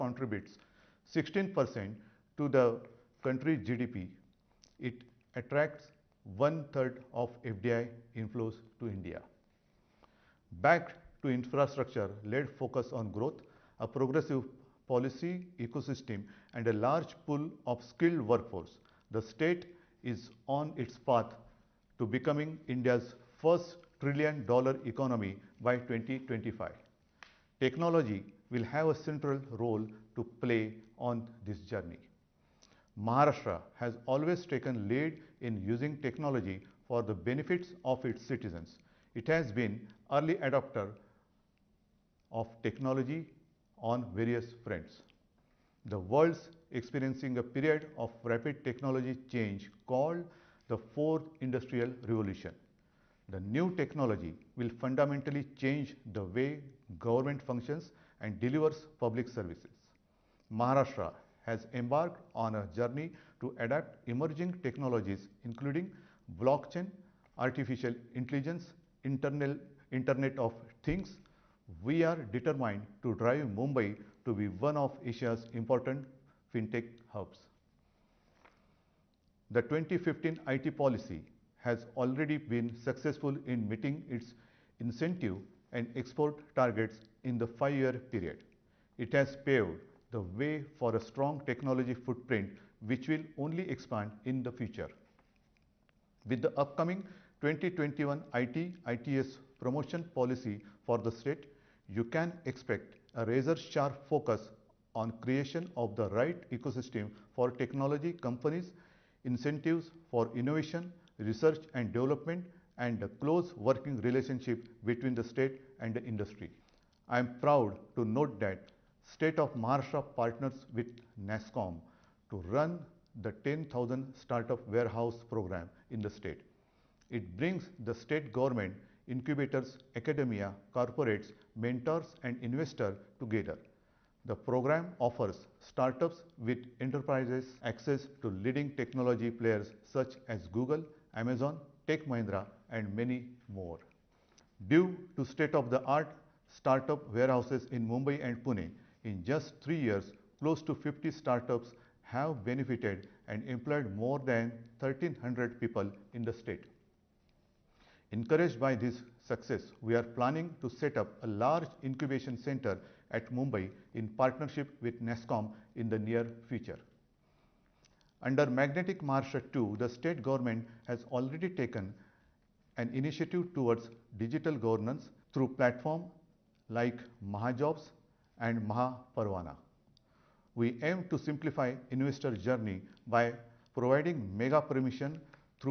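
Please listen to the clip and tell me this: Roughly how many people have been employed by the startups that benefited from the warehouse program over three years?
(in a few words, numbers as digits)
more than 1300.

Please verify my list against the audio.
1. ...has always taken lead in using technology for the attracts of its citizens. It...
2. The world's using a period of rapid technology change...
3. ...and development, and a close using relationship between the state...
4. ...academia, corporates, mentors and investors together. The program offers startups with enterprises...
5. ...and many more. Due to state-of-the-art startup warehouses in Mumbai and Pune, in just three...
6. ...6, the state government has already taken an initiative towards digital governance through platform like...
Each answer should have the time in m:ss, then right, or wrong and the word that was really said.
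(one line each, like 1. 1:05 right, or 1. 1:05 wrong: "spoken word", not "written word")
1. 0:33 wrong: "benefits", not "attracts"
2. 0:45 wrong: "experiencing", not "using"
3. 1:51 wrong: "working", not "using"
4. 2:09 right
5. 2:22 right
6. 2:49 wrong: "2", not "6".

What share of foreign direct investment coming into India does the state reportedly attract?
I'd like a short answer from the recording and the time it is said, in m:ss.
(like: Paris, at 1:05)
one-third, at 0:06.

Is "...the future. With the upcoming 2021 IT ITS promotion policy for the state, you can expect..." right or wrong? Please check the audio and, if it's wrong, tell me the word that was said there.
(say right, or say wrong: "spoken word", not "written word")
right.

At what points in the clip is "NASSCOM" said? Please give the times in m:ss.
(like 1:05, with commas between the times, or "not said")
2:01, 2:45.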